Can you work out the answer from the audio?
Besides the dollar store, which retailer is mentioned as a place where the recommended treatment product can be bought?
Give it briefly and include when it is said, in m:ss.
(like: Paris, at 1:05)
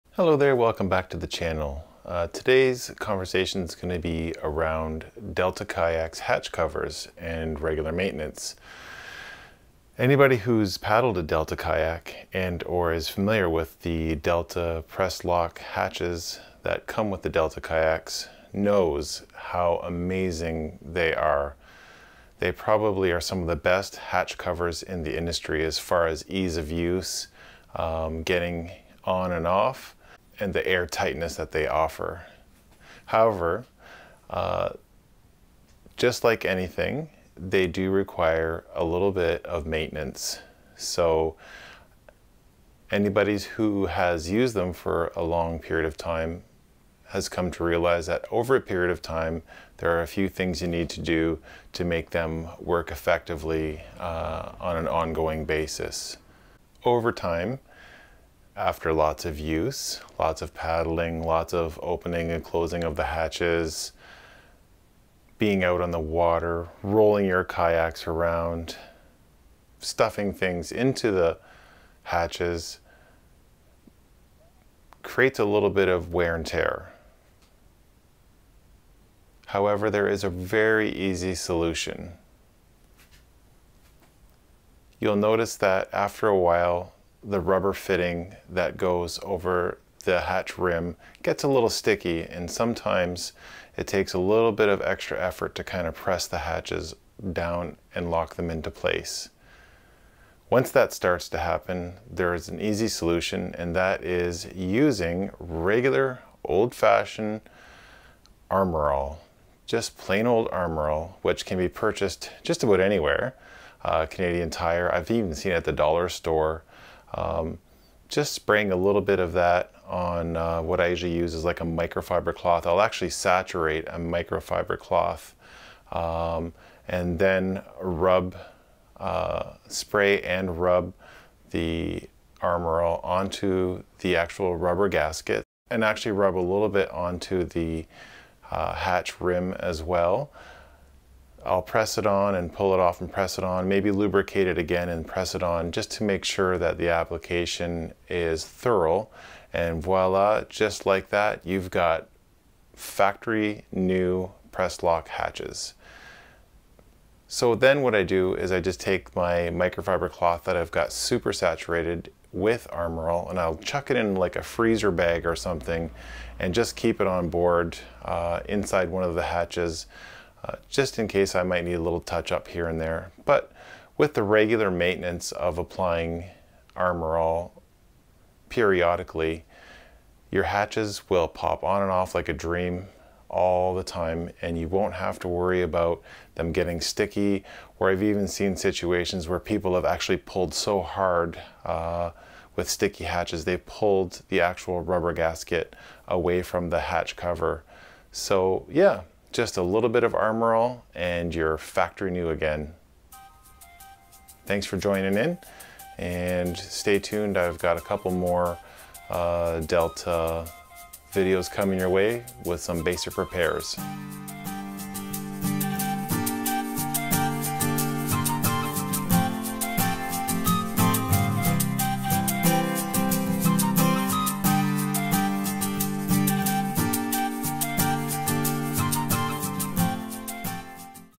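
Canadian Tire, at 1:54.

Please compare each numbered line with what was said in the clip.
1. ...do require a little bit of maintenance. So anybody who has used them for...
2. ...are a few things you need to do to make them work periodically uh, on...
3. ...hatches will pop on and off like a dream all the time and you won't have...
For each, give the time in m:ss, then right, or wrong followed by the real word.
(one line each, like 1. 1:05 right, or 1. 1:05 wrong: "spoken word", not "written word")
1. 0:37 right
2. 0:49 wrong: "effectively", not "periodically"
3. 3:00 right.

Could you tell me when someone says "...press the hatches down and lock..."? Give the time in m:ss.
1:35.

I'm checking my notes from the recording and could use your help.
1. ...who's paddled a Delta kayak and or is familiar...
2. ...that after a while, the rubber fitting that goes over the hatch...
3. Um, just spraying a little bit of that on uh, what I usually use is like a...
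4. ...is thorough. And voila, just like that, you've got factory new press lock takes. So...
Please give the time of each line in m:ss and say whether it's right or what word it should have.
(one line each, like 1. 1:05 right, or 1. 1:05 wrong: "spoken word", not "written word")
1. 0:10 right
2. 1:25 right
3. 1:57 right
4. 2:28 wrong: "hatches", not "takes".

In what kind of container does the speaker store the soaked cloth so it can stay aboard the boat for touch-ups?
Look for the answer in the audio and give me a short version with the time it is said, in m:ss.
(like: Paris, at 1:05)
Freezer bag, at 2:44.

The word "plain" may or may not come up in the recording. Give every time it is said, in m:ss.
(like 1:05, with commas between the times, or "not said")
1:49.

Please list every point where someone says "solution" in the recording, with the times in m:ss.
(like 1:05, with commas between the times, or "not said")
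1:21, 1:42.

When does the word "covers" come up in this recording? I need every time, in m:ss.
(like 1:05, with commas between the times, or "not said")
0:06, 0:24, 3:17.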